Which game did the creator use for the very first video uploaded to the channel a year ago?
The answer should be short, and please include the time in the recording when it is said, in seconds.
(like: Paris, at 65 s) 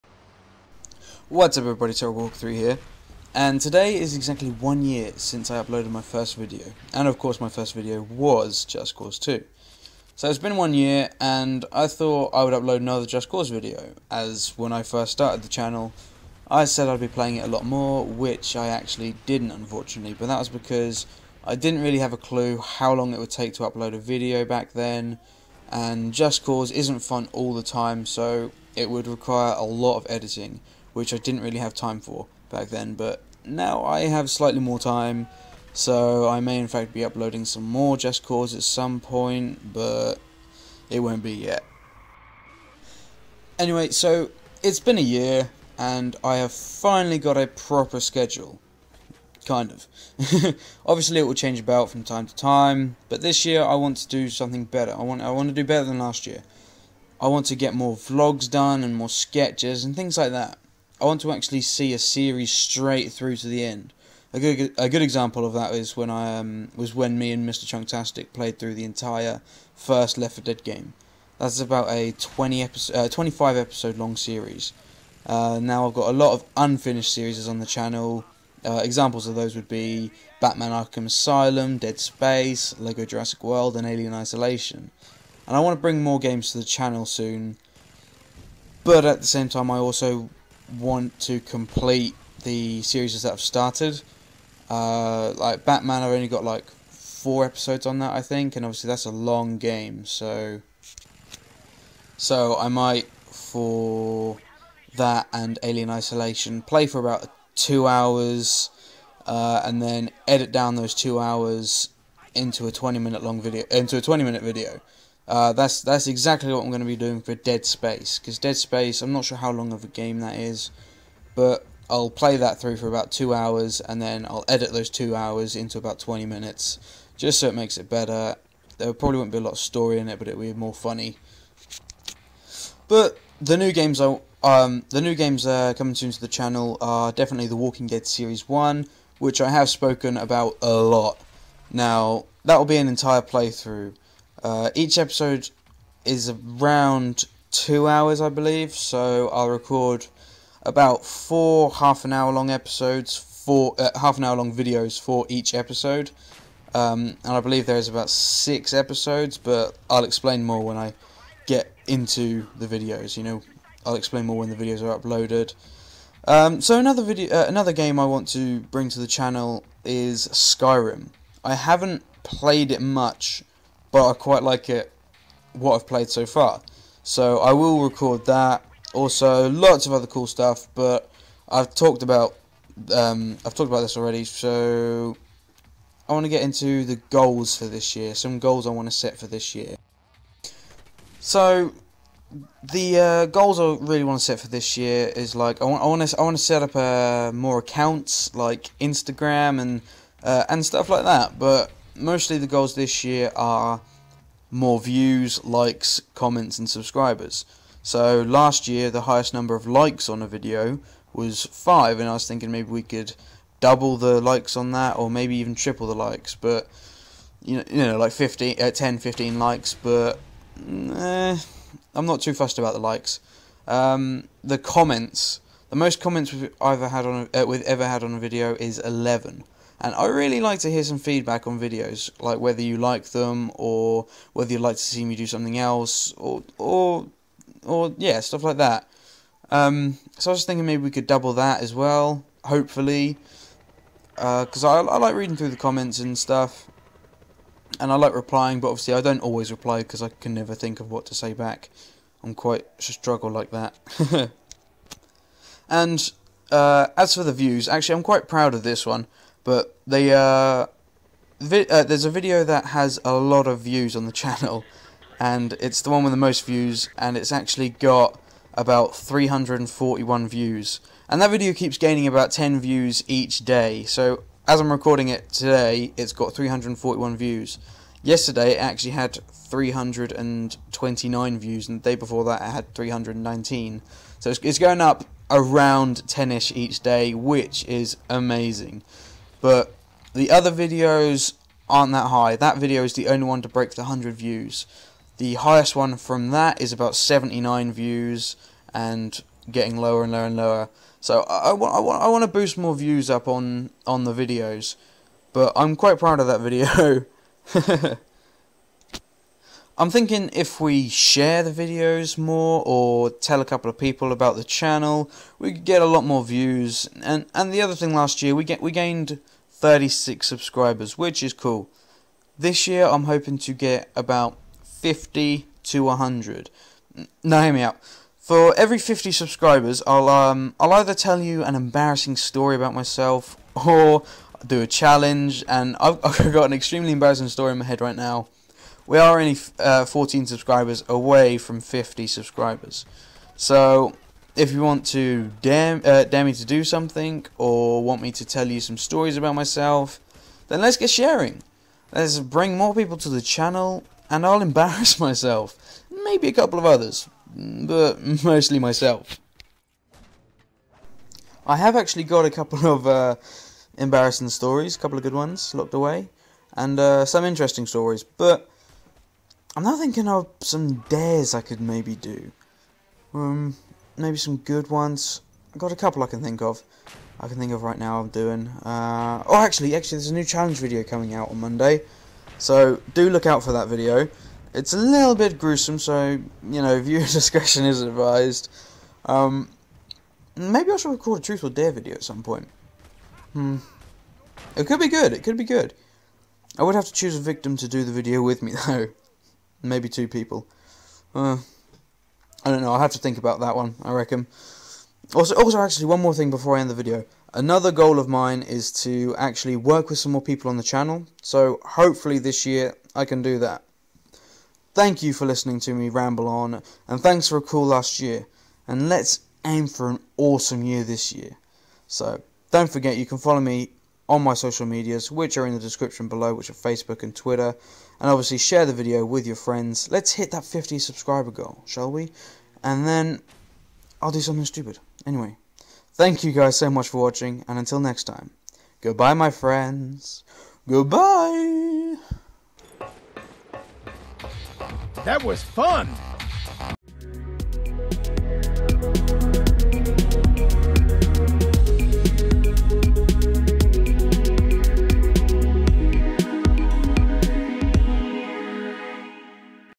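Just Cause 2, at 8 s.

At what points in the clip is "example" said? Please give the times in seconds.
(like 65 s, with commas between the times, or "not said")
65 s, 78 s.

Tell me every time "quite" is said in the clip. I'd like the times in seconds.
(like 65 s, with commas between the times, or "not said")
174 s, 252 s, 258 s, 305 s.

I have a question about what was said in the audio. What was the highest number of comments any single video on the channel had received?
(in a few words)
11.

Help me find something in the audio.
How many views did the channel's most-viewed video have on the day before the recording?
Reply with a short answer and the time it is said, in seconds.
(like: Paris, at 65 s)
329, at 279 s.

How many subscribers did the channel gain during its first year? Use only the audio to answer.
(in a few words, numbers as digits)
36.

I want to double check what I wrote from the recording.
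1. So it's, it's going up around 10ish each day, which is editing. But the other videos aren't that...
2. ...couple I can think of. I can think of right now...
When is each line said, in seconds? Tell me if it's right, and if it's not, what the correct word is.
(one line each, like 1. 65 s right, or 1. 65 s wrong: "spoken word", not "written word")
1. 284 s wrong: "amazing", not "editing"
2. 375 s right.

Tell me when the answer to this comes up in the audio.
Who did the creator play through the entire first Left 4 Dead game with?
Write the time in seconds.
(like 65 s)
67 s.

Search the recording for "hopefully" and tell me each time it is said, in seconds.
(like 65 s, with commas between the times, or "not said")
242 s, 411 s.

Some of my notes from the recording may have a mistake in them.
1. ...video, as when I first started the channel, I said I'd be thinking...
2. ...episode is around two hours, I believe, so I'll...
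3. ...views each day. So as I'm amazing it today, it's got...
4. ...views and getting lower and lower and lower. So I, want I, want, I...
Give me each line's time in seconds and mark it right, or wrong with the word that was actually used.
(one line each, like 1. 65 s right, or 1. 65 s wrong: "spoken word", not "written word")
1. 13 s wrong: "playing", not "thinking"
2. 144 s right
3. 272 s wrong: "recording", not "amazing"
4. 297 s right.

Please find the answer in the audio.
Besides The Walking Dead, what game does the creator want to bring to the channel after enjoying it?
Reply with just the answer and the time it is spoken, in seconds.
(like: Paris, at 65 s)
Skyrim, at 170 s.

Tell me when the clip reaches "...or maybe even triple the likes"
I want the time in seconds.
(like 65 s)
214 s.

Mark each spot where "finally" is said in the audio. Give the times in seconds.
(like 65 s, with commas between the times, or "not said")
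46 s.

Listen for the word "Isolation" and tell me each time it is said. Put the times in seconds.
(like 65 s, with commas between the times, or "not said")
84 s, 105 s.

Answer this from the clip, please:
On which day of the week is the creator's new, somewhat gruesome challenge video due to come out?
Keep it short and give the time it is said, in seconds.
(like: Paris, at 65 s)
Monday, at 381 s.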